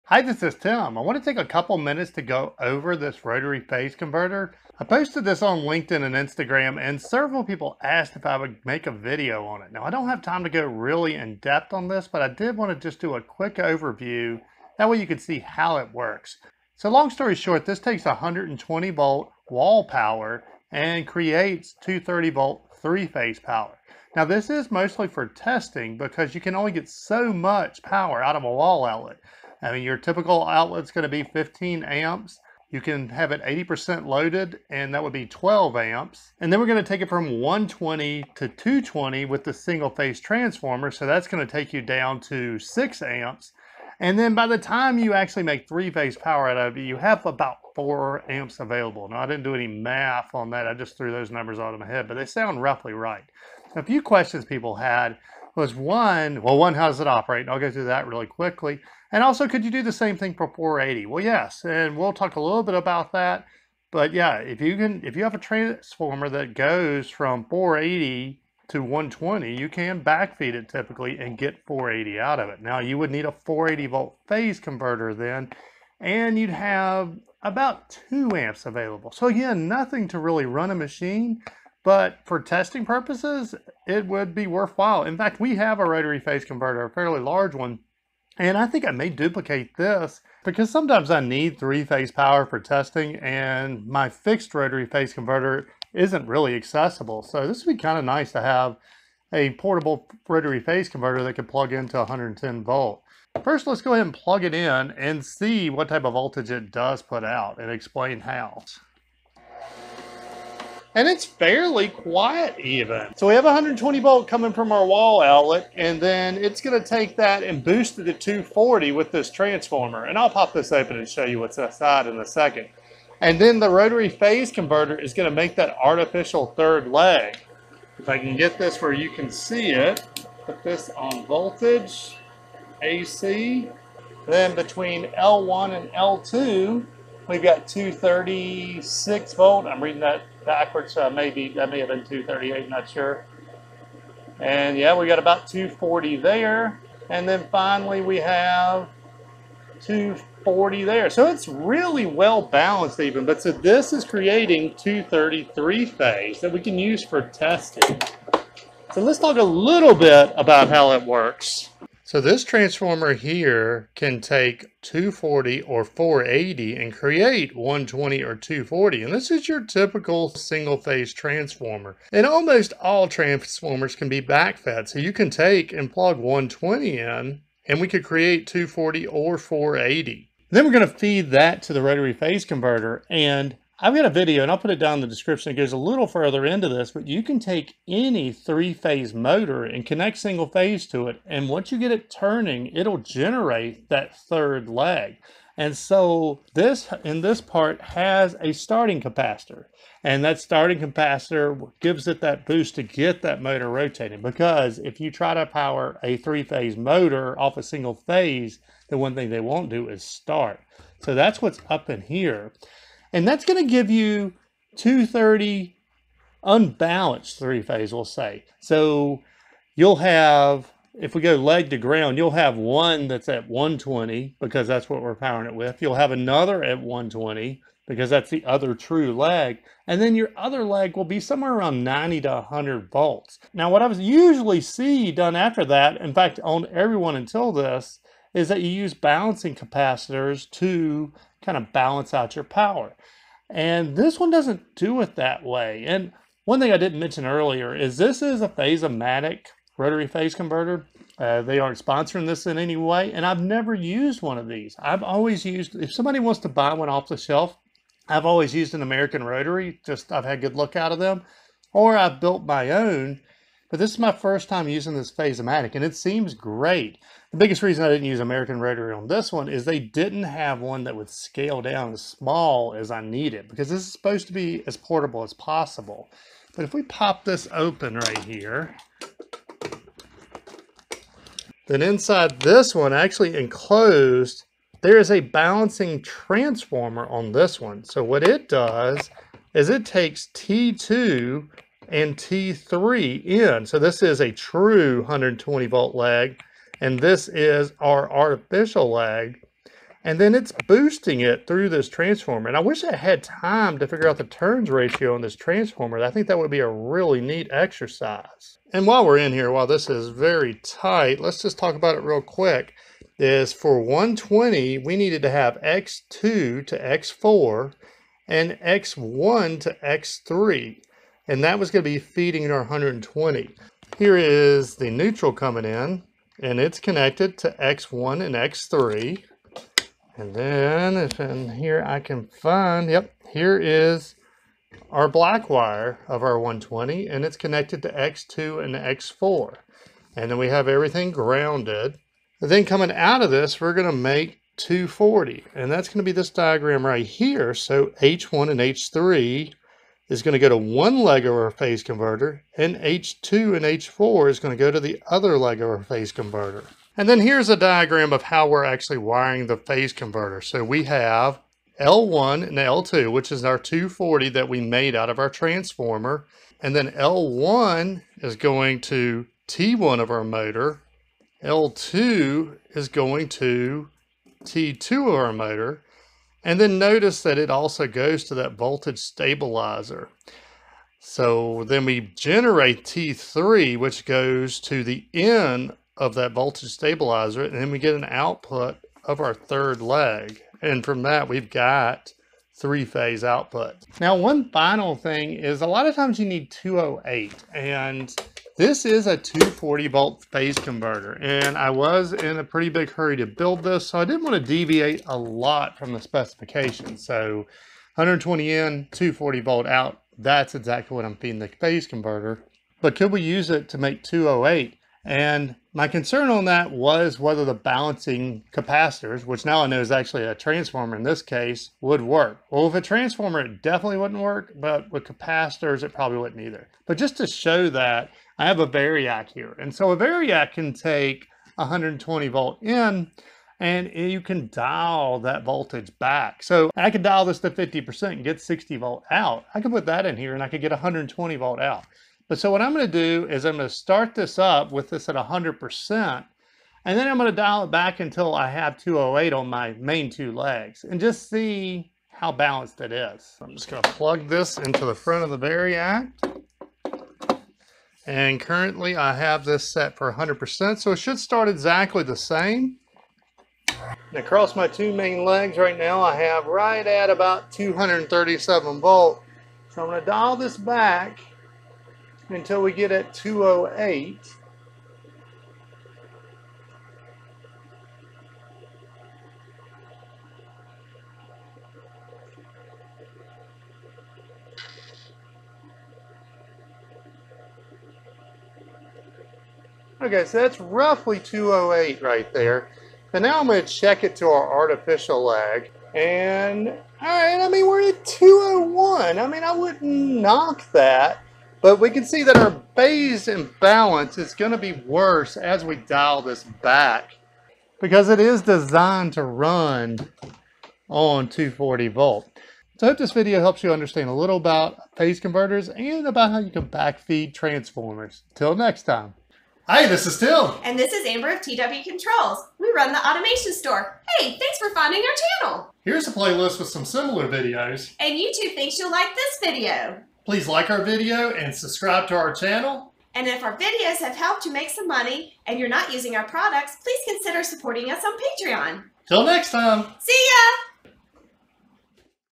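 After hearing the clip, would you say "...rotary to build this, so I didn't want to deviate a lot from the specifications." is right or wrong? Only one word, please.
wrong.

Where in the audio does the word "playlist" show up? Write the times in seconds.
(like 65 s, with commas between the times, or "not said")
526 s.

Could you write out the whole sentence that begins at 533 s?
And if our videos have helped you make some money and you're not using our products, please consider supporting us on Patreon.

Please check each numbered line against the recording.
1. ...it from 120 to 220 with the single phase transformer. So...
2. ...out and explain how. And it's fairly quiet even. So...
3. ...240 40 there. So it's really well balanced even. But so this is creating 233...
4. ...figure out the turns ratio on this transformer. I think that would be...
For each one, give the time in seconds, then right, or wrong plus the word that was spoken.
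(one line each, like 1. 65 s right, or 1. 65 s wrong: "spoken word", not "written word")
1. 37 s right
2. 107 s right
3. 149 s right
4. 303 s right.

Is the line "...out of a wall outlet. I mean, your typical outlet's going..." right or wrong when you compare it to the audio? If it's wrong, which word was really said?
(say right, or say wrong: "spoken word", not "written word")
right.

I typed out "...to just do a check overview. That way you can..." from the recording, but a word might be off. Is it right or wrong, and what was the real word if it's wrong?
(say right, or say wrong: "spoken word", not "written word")
wrong: "quick", not "check".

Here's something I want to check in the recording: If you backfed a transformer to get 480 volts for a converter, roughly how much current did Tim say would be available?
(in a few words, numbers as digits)
2 amps.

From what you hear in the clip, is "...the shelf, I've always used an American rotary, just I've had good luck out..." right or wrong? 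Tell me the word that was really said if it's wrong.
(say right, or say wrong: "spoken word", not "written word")
right.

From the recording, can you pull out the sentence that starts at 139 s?
I'm reading that backwards, so maybe that may have been 238, not sure.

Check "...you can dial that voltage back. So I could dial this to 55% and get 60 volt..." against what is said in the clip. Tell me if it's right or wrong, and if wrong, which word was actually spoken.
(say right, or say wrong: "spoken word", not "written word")
wrong: "50", not "55".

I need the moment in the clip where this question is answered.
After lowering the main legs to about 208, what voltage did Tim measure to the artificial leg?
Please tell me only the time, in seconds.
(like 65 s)
498 s.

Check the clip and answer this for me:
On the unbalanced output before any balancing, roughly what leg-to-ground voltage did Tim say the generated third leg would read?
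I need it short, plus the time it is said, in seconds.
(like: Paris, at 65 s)
90 to 100 volts, at 231 s.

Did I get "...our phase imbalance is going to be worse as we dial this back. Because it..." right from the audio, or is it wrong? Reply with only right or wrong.
right.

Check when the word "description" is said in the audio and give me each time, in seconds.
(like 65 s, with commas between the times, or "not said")
185 s.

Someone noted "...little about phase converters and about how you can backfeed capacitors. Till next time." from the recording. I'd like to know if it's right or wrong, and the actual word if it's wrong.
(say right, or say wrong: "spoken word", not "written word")
wrong: "transformers", not "capacitors".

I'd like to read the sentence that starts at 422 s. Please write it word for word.
Well, with a transformer, it definitely wouldn't work, but with capacitors, it probably wouldn't either.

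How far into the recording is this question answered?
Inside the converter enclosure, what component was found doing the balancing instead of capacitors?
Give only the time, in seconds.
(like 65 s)
285 s.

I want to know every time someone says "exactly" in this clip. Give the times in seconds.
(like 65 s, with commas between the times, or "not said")
410 s, 461 s.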